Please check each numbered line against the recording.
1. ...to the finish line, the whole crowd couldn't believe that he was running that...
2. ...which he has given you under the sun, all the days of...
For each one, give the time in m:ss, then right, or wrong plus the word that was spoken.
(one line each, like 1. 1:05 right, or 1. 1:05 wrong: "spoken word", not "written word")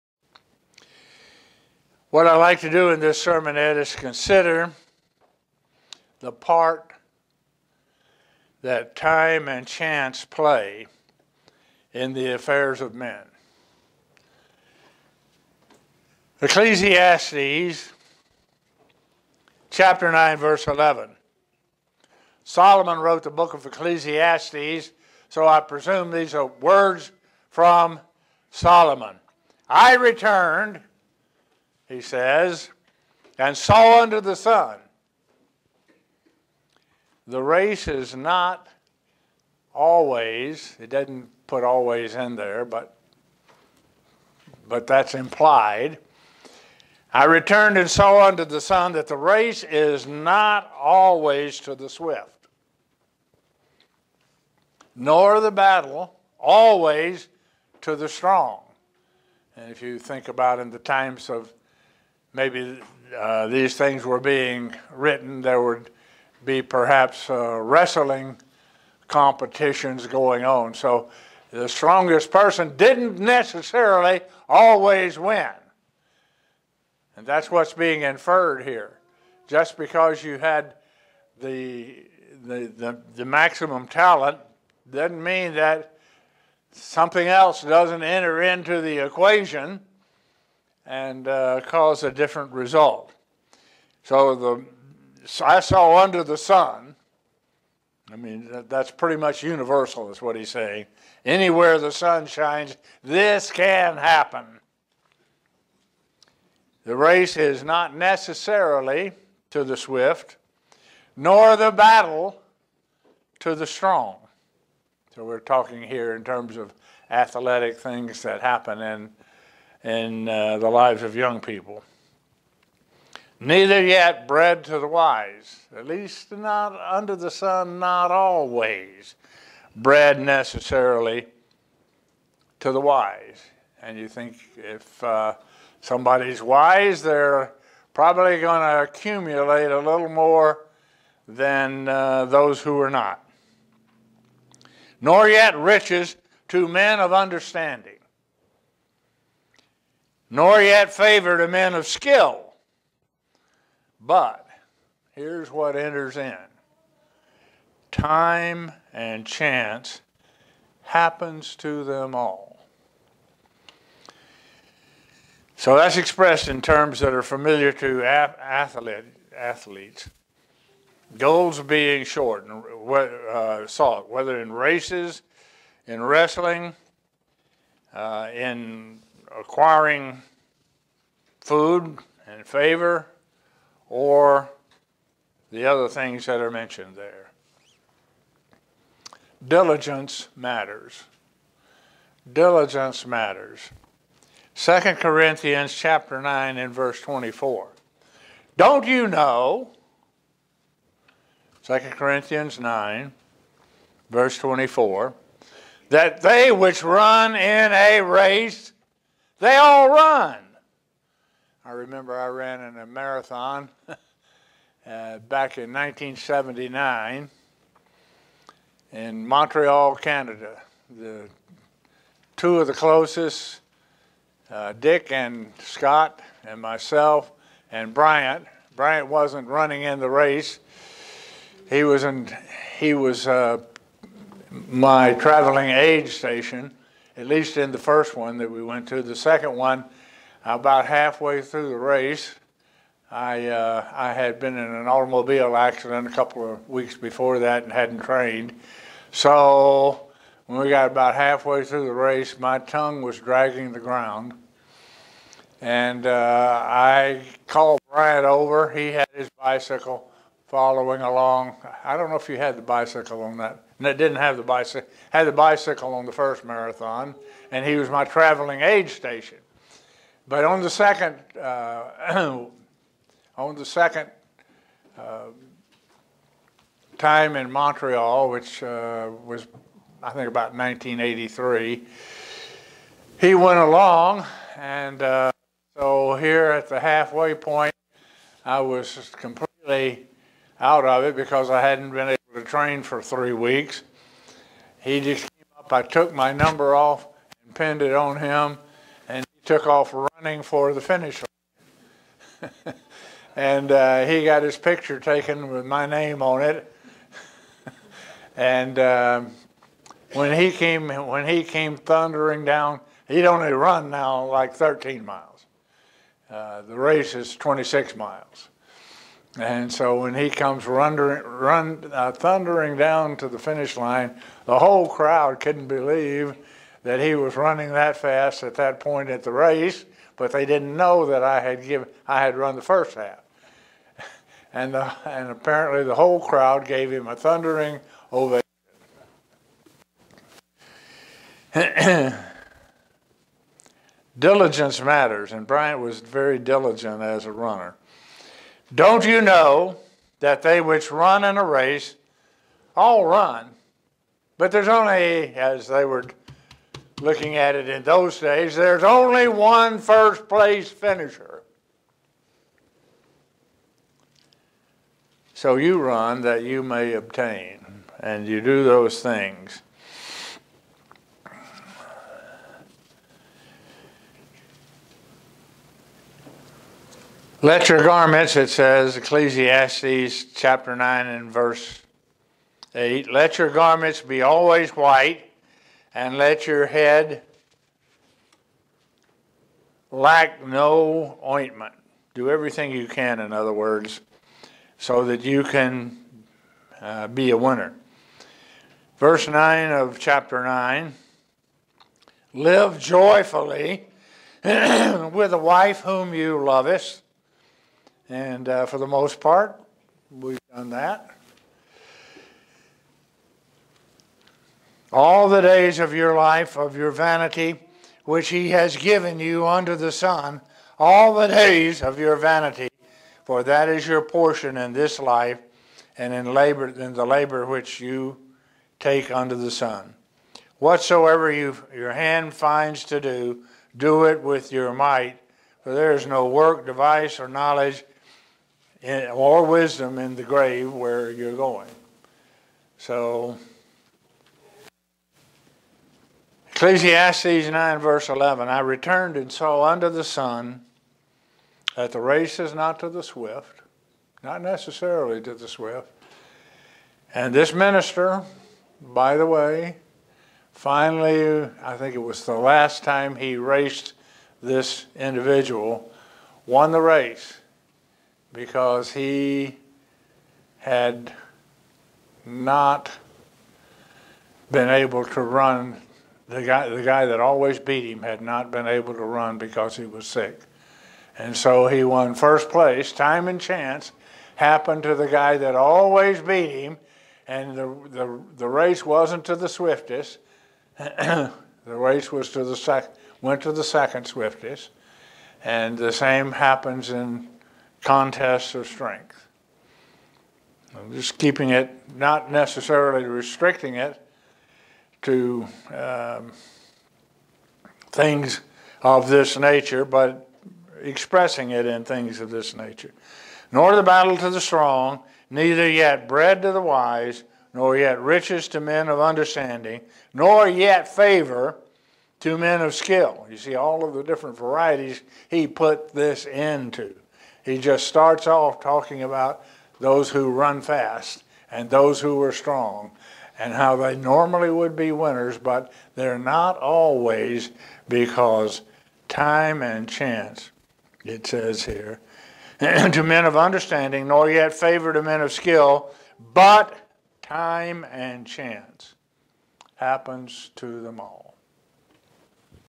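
1. 5:23 right
2. 6:58 right.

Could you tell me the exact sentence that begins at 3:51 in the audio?
He was in, he was uh, my traveling aid station at least in the first one that we went to.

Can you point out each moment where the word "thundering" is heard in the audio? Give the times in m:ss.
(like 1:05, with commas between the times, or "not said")
5:11, 5:22, 5:37.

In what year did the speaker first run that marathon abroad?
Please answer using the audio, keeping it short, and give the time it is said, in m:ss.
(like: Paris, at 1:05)
1979, at 3:35.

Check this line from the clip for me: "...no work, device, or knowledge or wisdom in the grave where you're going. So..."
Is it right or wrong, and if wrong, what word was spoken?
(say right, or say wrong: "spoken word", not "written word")
right.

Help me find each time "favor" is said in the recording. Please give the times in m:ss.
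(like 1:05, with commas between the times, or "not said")
2:30, 3:02, 8:40, 9:04.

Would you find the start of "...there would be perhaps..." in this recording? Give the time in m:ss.
1:05.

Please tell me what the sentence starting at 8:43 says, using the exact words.
You see all of the different varieties he put this into.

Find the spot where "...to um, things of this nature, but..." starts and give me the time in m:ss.
8:25.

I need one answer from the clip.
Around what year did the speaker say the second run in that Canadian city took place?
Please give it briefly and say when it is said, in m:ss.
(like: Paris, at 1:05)
1983, at 4:40.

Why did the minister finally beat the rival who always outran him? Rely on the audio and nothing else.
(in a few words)
He was sick.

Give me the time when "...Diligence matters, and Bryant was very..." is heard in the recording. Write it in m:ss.
5:44.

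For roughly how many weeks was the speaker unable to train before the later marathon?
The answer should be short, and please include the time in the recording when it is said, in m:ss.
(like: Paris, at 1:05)
3, at 4:53.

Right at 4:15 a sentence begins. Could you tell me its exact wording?
And uh, I called Brian over.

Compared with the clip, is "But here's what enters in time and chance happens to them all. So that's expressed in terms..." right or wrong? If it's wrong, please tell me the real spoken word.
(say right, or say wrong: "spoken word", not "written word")
right.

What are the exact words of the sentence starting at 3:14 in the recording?
2 Corinthians chapter 9 and verse 24.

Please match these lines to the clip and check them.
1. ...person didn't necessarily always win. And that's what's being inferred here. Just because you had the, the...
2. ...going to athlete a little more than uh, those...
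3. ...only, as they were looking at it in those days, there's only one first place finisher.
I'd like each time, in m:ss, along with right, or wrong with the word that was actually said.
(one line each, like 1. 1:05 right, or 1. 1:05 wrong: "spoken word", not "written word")
1. 1:12 right
2. 2:18 wrong: "accumulate", not "athlete"
3. 5:54 right.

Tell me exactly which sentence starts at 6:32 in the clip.
Do everything you can, in other words, so that you can uh, be a winner.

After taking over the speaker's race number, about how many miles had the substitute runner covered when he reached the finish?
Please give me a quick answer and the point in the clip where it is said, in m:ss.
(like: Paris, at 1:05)
13, at 5:14.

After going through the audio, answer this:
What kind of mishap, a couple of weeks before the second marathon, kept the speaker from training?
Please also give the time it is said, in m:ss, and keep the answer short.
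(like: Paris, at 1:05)
Automobile accident, at 4:04.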